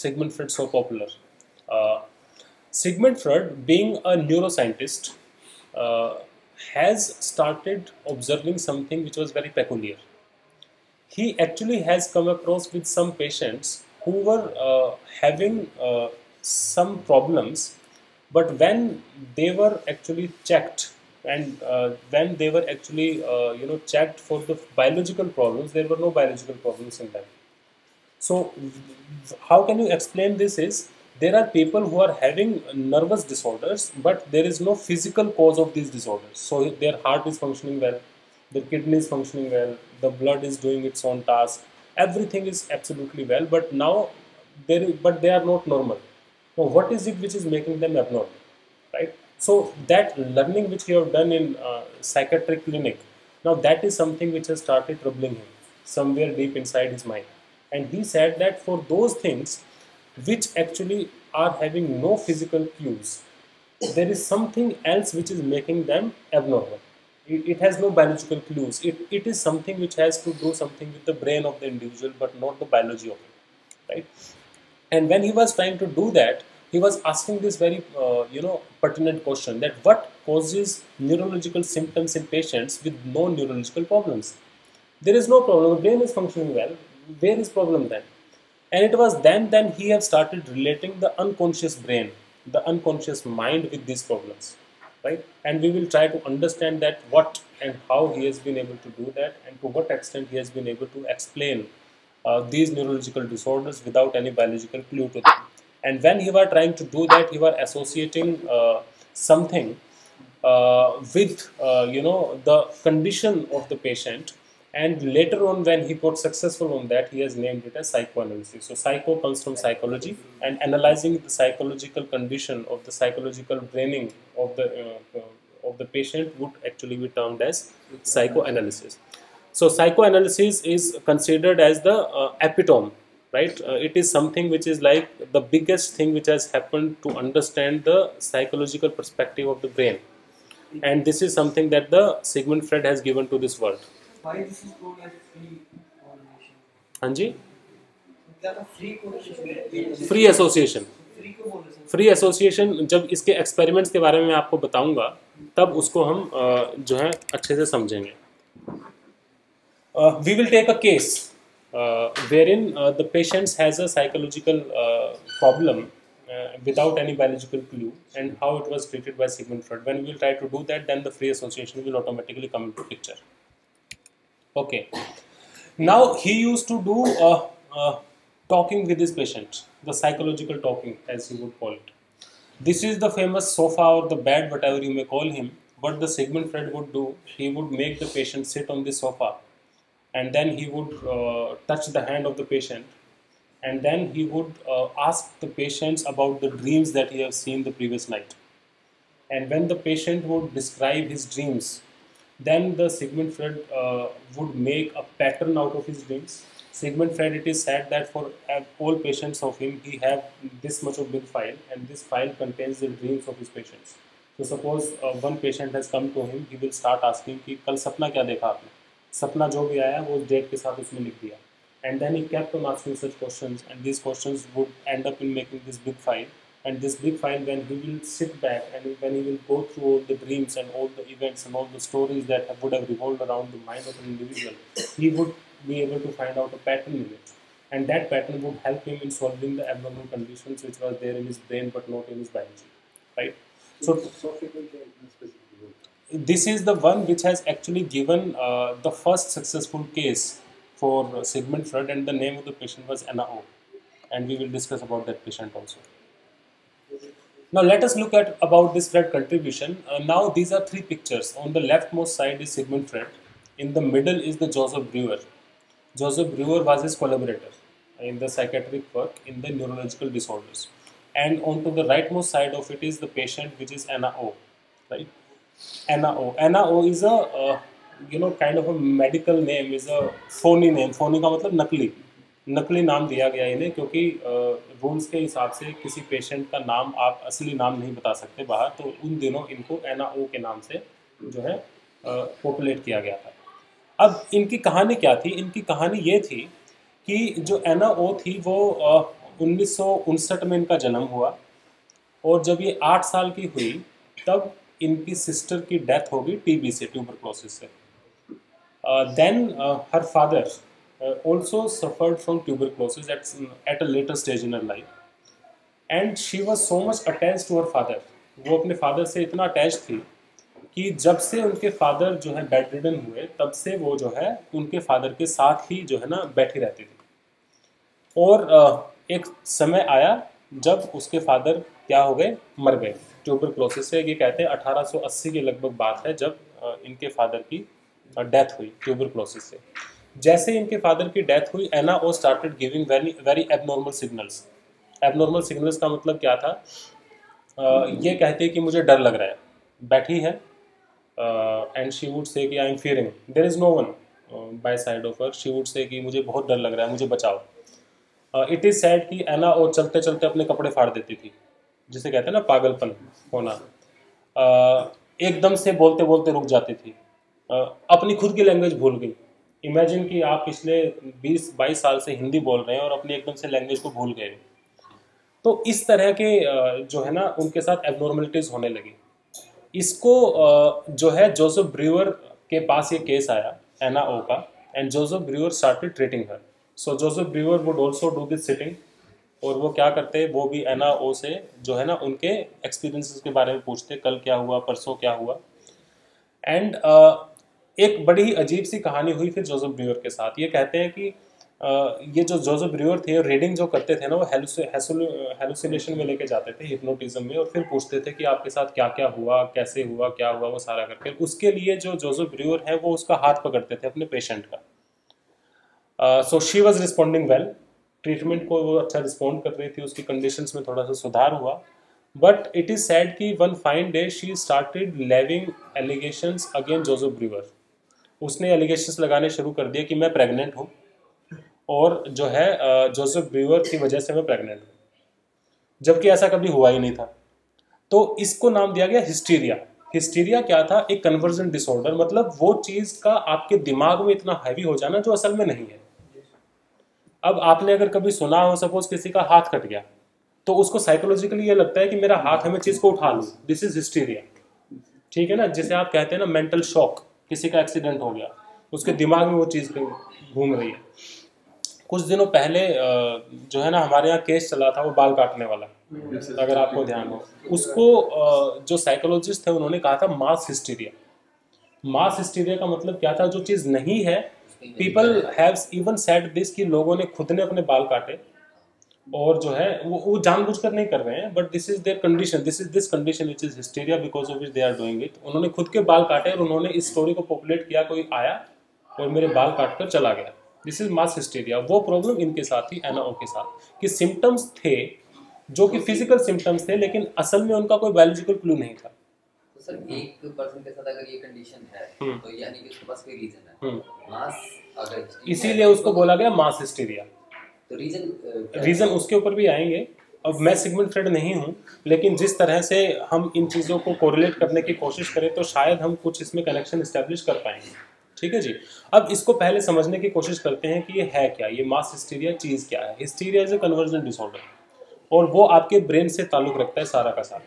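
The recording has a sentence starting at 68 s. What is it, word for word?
It, it is something which has to do something with the brain of the individual but not the biology of it, right?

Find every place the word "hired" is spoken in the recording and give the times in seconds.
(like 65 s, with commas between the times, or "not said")
not said.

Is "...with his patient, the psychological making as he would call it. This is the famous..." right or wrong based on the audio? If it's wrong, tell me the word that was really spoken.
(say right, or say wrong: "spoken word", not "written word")
wrong: "talking", not "making".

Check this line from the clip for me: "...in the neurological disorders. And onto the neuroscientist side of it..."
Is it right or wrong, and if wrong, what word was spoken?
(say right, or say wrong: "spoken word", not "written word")
wrong: "rightmost", not "neuroscientist".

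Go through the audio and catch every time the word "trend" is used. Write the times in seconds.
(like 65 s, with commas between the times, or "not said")
not said.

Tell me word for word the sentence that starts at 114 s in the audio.
And later on, when he got successful on that, he has named it as psychoanalysis.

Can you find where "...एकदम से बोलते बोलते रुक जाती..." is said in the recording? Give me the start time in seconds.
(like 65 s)
365 s.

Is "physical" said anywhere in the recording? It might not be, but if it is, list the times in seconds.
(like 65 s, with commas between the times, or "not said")
34 s, 62 s.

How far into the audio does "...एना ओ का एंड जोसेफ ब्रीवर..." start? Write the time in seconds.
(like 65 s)
383 s.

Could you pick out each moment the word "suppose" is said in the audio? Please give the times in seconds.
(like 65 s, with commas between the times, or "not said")
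214 s.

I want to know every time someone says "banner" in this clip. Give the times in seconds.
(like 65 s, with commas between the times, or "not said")
not said.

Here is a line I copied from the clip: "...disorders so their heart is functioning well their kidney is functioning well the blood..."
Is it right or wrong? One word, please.
right.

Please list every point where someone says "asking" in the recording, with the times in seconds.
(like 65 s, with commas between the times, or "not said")
77 s, 217 s, 222 s.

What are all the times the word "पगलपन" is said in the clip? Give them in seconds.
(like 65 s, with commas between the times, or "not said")
362 s.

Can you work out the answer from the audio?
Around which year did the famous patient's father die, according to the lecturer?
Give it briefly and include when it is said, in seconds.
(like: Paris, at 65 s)
1880, at 334 s.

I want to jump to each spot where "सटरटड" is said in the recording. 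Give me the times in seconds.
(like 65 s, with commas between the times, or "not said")
342 s, 385 s, 424 s.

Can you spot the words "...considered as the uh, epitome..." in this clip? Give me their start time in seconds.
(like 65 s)
131 s.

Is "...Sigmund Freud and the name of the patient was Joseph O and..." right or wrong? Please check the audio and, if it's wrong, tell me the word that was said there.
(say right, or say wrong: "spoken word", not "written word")
wrong: "Anna", not "Joseph".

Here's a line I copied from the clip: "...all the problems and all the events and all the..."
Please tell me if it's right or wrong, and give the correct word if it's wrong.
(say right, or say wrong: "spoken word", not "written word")
wrong: "dreams", not "problems".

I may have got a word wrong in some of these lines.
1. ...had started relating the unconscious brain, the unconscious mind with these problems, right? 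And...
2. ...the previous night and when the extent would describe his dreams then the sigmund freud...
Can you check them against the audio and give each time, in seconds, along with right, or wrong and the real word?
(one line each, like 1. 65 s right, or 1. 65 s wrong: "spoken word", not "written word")
1. 89 s right
2. 197 s wrong: "patient", not "extent".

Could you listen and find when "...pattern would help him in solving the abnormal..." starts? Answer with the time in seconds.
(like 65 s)
238 s.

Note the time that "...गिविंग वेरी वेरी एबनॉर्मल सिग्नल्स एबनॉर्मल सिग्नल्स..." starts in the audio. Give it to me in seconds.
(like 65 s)
342 s.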